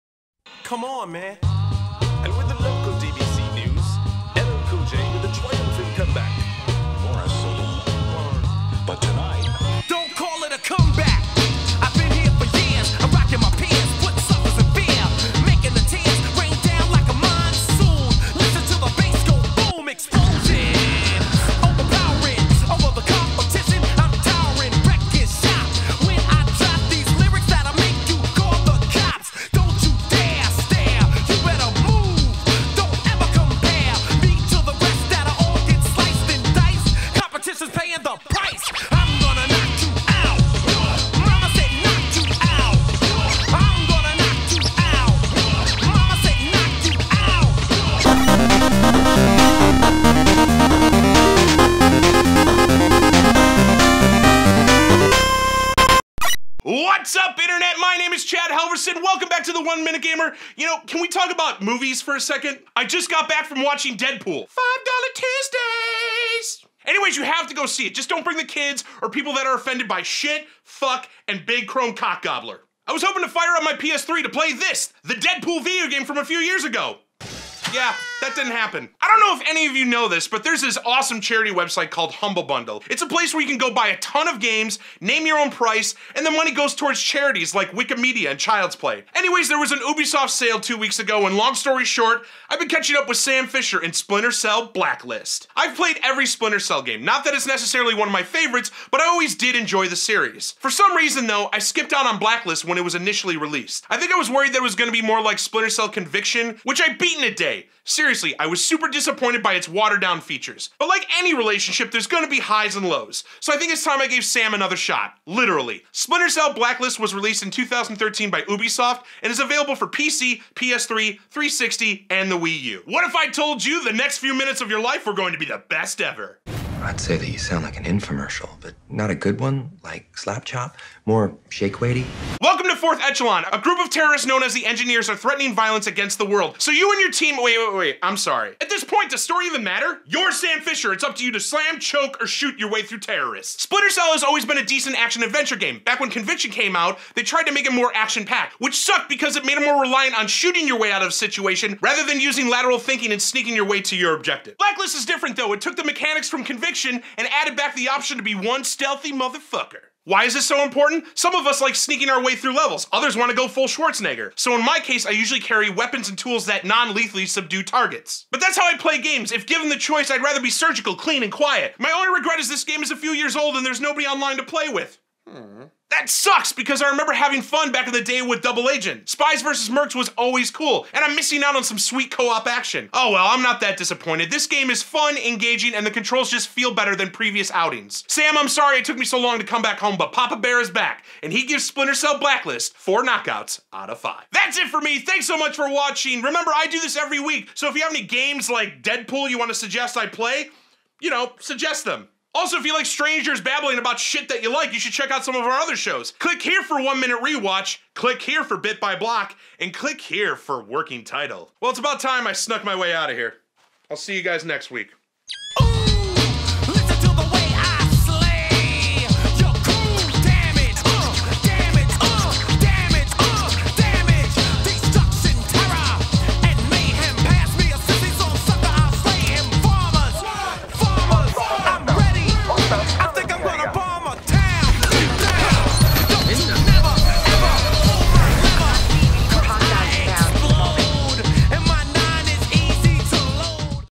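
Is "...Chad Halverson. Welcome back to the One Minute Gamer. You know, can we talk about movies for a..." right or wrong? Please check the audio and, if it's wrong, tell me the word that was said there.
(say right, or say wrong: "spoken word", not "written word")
right.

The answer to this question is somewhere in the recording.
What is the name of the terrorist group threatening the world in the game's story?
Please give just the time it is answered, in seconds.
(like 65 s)
134 s.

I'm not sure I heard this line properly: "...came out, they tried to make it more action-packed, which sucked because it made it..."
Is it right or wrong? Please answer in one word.
right.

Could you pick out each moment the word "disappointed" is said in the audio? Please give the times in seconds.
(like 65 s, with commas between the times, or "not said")
108 s, 183 s.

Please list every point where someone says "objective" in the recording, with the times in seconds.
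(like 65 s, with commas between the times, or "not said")
154 s.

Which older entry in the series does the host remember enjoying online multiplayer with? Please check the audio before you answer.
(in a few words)
Double Agent.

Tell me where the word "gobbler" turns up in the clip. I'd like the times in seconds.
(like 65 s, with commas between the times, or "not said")
72 s.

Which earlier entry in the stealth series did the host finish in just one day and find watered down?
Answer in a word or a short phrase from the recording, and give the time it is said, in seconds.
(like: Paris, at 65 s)
Splinter Cell Conviction, at 105 s.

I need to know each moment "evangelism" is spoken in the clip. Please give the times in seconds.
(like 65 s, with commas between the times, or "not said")
not said.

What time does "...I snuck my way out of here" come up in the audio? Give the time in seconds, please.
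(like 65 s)
212 s.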